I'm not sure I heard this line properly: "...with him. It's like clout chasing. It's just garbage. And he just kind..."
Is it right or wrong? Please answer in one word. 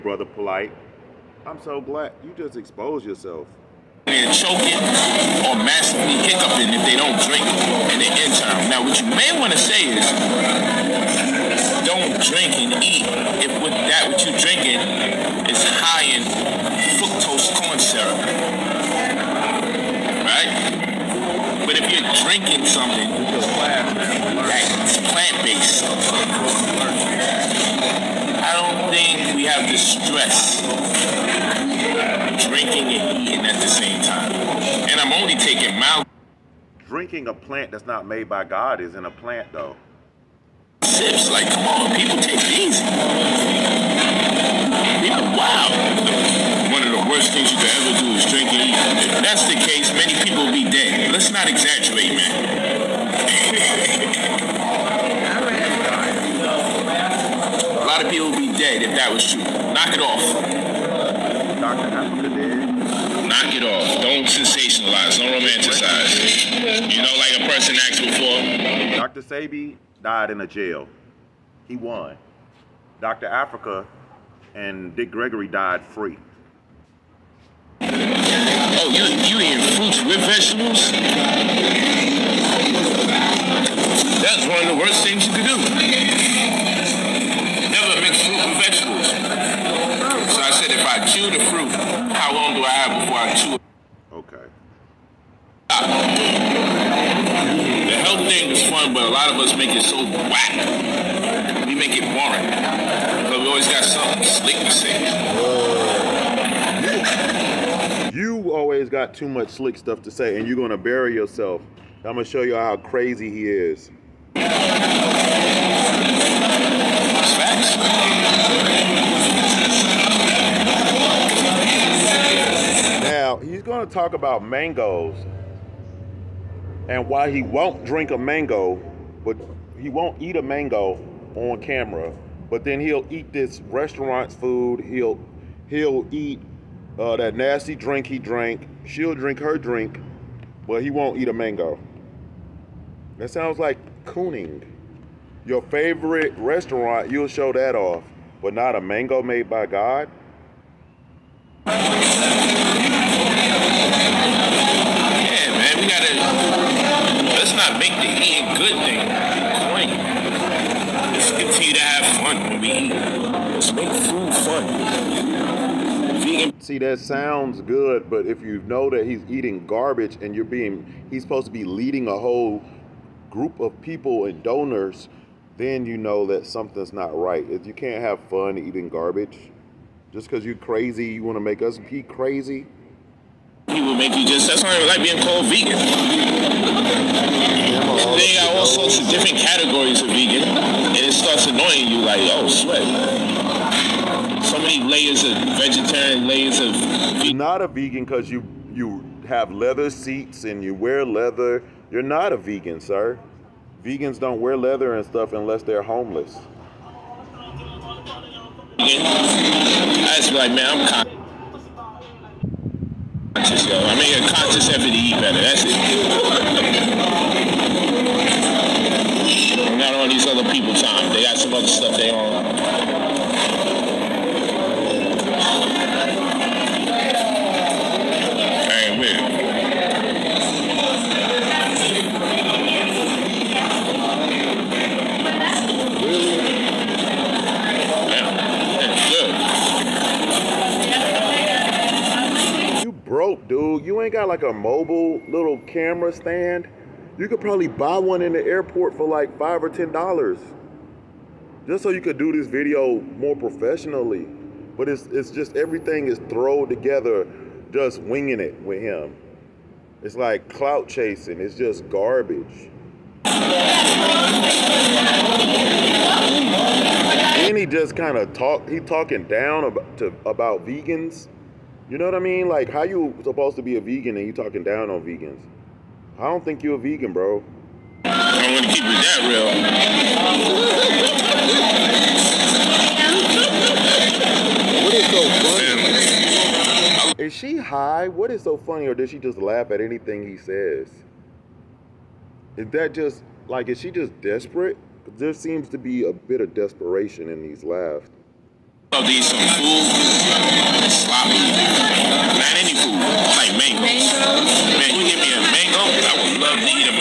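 right.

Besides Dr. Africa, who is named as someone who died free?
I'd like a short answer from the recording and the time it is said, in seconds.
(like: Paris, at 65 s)
Dick Gregory, at 74 s.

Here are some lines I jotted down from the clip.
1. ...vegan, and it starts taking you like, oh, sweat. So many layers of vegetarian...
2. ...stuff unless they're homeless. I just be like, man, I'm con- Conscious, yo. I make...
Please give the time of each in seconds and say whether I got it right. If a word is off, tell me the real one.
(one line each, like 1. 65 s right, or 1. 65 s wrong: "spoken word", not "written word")
1. 190 s wrong: "annoying", not "taking"
2. 205 s right.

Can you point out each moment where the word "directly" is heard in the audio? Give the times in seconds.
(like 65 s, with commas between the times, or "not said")
not said.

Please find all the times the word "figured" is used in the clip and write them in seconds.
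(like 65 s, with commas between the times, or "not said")
not said.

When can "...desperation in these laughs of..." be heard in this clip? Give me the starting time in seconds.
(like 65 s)
296 s.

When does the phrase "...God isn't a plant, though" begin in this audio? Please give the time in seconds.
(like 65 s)
38 s.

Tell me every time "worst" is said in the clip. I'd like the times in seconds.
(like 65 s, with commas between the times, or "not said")
47 s, 84 s.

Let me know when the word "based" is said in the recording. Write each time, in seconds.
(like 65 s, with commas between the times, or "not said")
25 s.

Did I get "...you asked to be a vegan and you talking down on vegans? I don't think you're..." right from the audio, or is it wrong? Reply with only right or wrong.
wrong.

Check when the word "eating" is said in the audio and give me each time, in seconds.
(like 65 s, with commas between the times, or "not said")
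33 s, 79 s, 158 s, 169 s, 178 s.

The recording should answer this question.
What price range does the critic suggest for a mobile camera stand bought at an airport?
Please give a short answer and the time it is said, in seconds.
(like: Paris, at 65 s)
5 or 10 dollars, at 249 s.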